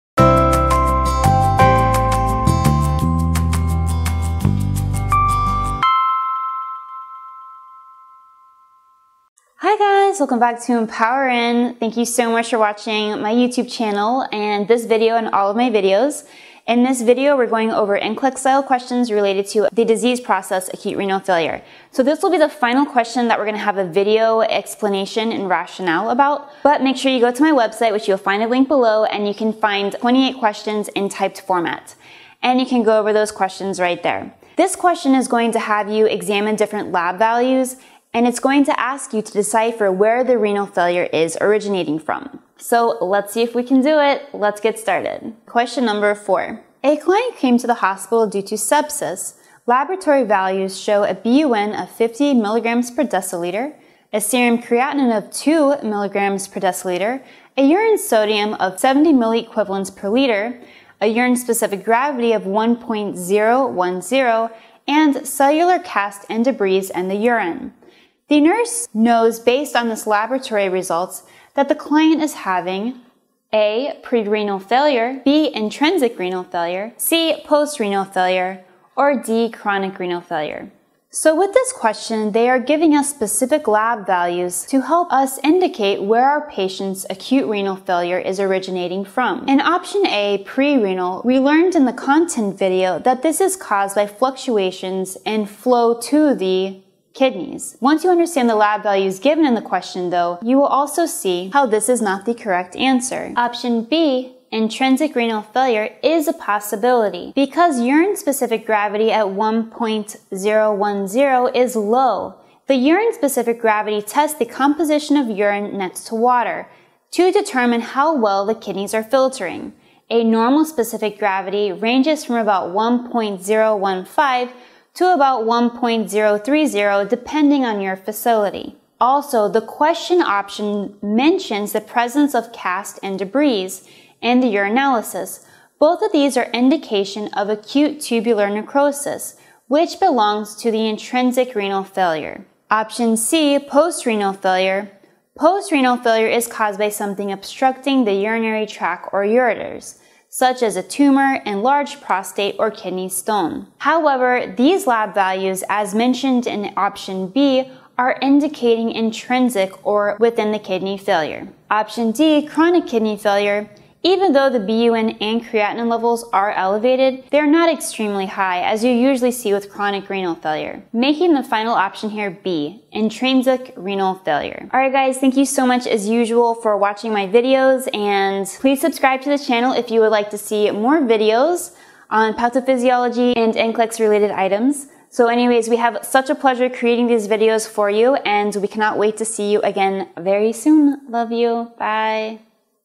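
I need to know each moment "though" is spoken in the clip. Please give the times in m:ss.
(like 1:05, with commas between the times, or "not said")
1:40, 2:44.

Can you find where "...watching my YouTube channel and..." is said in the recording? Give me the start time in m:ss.
0:12.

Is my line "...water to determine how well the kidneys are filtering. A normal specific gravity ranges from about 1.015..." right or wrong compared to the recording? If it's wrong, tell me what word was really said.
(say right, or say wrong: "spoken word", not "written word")
right.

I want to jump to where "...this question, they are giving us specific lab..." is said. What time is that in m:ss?
1:21.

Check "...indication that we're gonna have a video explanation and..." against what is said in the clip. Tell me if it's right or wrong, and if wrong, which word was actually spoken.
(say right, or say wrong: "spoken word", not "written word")
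wrong: "question", not "indication".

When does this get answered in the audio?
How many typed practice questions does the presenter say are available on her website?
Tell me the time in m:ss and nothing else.
0:30.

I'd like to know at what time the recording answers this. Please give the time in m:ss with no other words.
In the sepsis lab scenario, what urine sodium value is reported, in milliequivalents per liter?
0:58.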